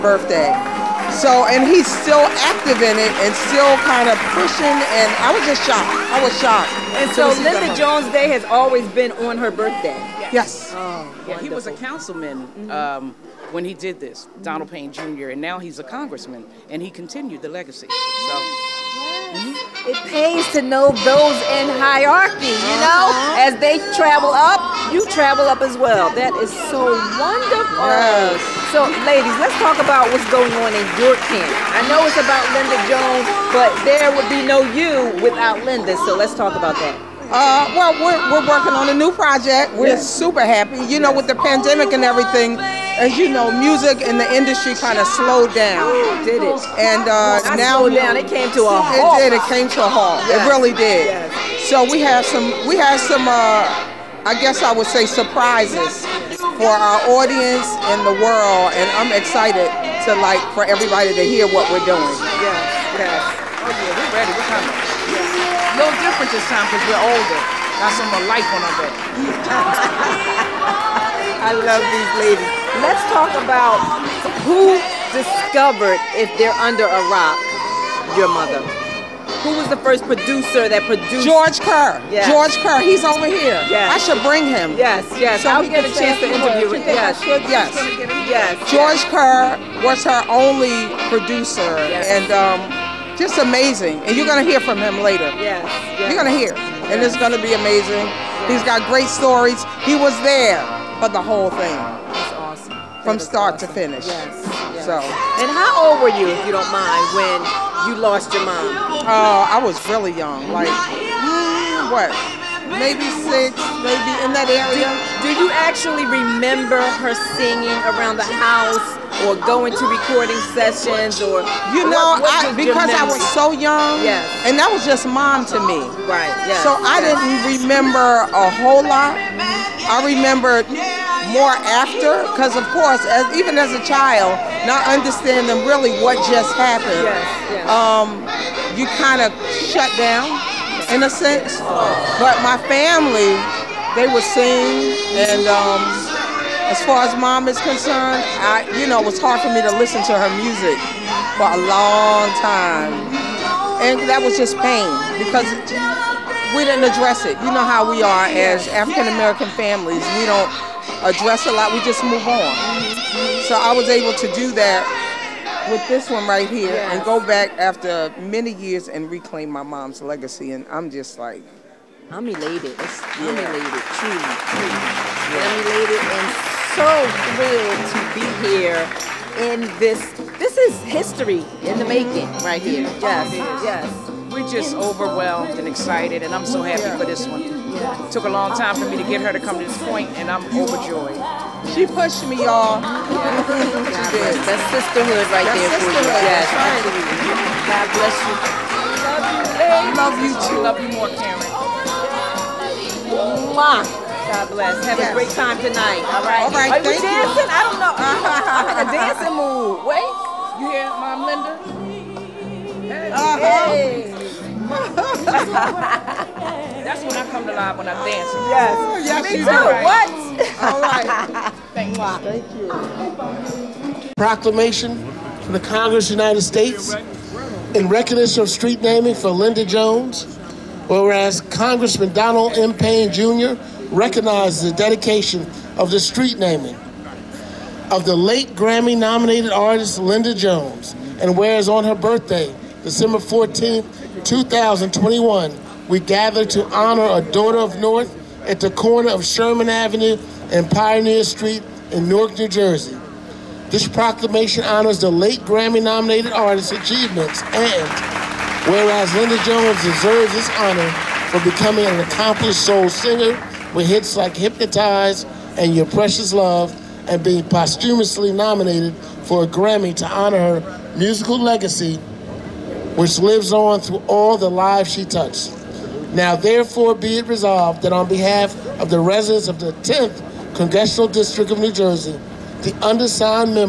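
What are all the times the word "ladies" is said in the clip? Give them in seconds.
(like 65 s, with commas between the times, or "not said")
29 s, 72 s, 199 s.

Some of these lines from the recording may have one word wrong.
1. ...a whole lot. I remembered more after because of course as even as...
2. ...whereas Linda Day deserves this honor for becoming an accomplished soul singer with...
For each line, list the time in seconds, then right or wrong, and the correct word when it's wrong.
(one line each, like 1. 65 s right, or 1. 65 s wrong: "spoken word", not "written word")
1. 128 s right
2. 258 s wrong: "Jones", not "Day".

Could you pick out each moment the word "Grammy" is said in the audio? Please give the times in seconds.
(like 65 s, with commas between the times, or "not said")
238 s, 255 s, 269 s.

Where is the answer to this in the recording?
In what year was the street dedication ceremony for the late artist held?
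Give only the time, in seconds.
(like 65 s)
244 s.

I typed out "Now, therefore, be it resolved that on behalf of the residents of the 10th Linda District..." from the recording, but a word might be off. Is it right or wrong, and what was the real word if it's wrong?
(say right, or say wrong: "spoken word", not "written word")
wrong: "Congressional", not "Linda".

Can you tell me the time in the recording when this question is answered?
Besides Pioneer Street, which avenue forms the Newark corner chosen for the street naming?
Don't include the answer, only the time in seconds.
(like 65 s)
249 s.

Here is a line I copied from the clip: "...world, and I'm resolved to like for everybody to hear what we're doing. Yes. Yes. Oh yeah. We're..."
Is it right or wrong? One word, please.
wrong.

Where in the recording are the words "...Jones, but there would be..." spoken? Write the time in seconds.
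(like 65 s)
32 s.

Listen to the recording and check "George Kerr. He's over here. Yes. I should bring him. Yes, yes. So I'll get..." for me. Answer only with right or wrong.
right.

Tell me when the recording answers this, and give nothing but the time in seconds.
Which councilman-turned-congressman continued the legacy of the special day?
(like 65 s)
14 s.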